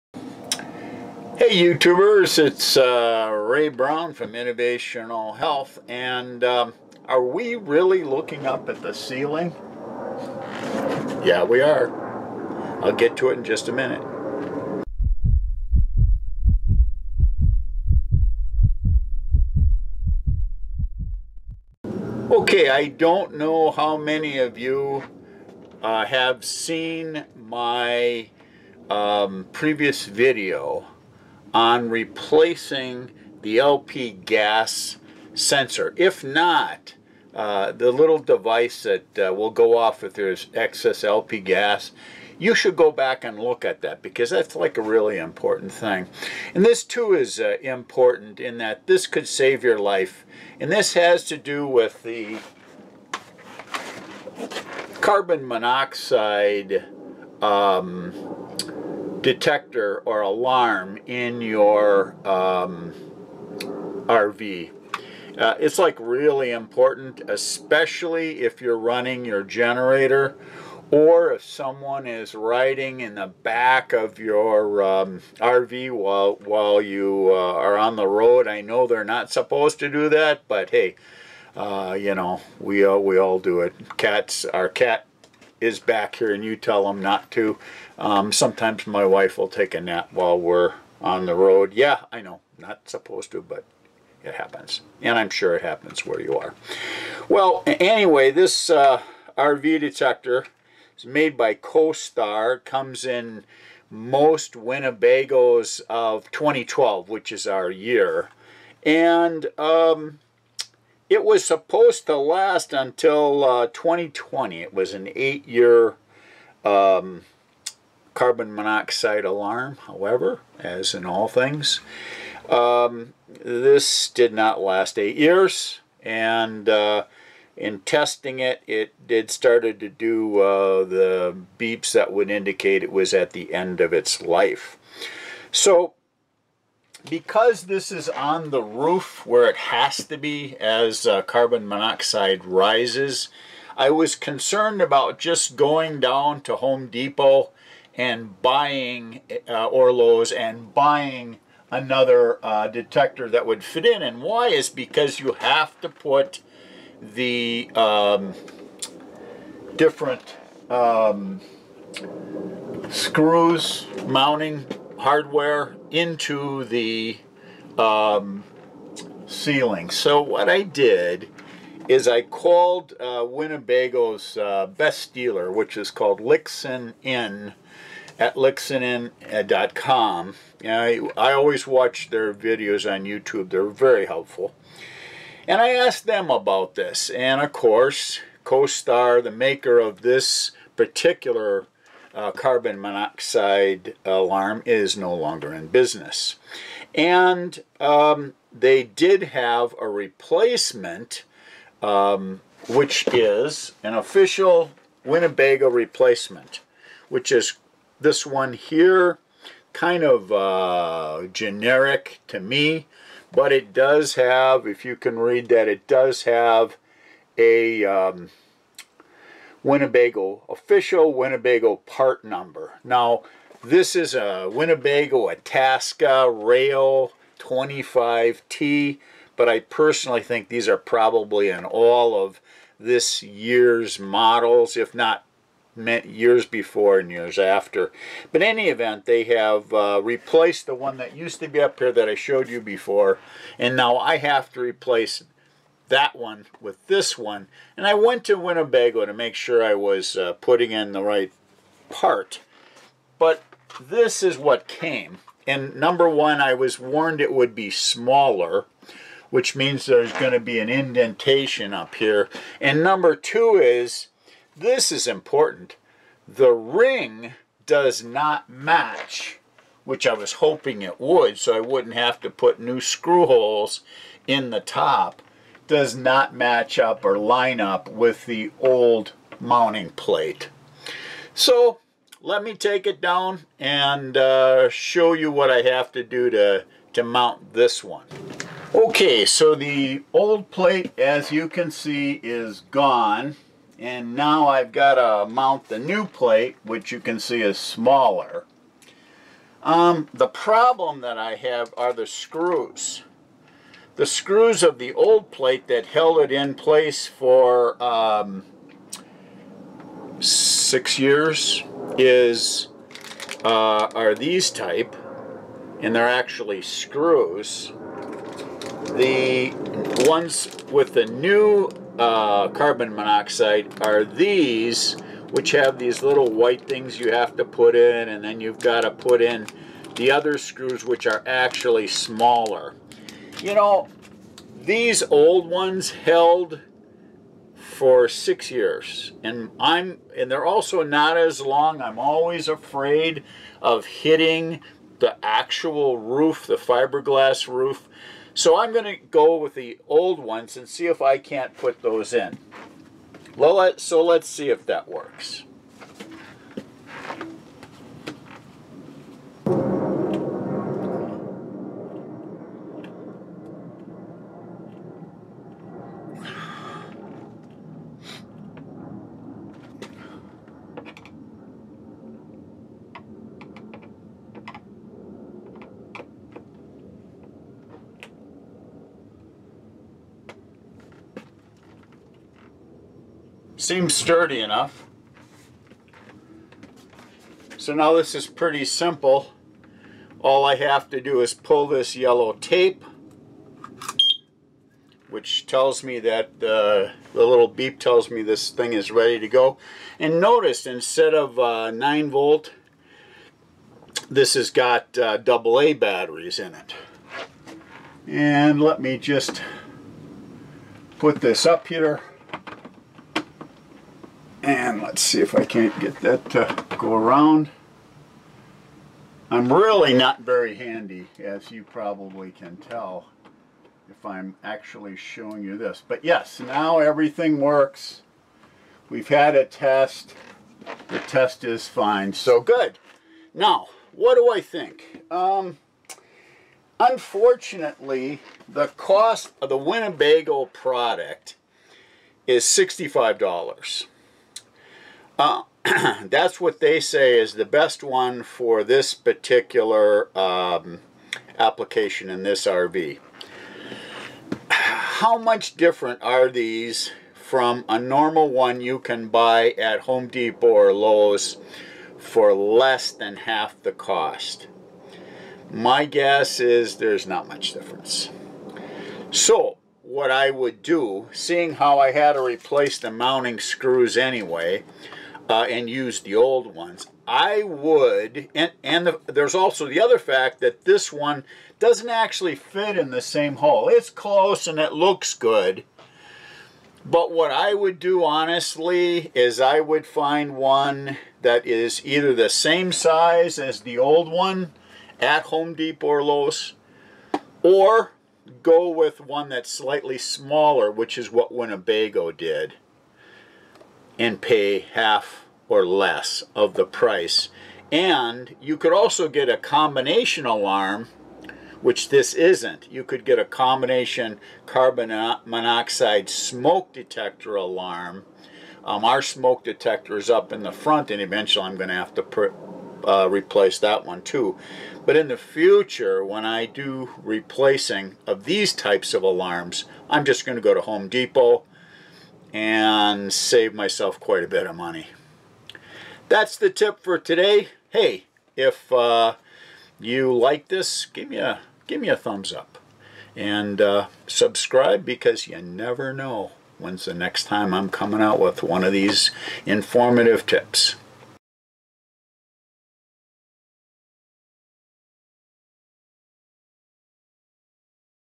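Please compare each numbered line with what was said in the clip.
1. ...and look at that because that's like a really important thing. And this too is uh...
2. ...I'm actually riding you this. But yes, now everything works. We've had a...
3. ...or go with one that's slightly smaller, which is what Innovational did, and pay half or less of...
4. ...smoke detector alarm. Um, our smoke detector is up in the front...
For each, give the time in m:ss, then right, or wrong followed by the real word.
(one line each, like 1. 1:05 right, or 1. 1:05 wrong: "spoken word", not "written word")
1. 0:43 right
2. 7:04 wrong: "showing", not "riding"
3. 8:17 wrong: "Winnebago", not "Innovational"
4. 8:36 right.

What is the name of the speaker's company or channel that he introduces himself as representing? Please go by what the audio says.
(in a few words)
Innovational Health.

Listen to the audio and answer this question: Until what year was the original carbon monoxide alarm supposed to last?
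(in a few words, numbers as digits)
2020.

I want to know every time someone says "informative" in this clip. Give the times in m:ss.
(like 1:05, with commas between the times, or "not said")
9:09.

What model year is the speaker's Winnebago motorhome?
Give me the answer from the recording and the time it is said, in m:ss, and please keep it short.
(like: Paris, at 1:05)
2012, at 1:46.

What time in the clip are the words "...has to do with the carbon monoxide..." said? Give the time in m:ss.
0:50.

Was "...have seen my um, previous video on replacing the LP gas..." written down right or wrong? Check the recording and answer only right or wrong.
right.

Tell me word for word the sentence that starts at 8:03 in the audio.
It's close and it looks good.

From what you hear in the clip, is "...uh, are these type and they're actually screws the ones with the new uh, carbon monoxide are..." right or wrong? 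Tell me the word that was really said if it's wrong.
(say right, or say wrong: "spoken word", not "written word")
right.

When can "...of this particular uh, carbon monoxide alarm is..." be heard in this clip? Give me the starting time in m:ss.
3:09.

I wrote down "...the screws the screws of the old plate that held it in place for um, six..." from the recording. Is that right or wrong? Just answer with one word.
right.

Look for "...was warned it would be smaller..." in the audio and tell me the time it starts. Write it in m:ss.
4:16.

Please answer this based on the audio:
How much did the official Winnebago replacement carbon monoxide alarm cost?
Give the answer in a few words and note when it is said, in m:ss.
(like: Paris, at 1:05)
$65, at 7:22.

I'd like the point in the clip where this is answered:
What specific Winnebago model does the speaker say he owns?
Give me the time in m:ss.
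3:45.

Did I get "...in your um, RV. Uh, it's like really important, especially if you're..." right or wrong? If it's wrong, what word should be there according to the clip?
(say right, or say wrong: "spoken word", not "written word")
right.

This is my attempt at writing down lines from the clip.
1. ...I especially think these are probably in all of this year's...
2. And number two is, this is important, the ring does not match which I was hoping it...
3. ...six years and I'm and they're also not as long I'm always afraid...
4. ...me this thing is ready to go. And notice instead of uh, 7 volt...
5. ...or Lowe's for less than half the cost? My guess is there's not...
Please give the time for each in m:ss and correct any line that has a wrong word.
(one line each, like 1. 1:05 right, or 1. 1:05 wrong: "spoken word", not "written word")
1. 3:49 wrong: "personally", not "especially"
2. 4:22 right
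3. 5:38 right
4. 6:38 wrong: "9", not "7"
5. 7:40 right.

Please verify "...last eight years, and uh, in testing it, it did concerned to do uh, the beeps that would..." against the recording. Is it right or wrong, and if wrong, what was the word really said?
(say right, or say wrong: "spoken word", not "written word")
wrong: "started", not "concerned".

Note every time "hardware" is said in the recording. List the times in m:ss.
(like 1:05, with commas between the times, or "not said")
2:45.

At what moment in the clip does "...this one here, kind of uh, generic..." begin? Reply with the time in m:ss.
3:27.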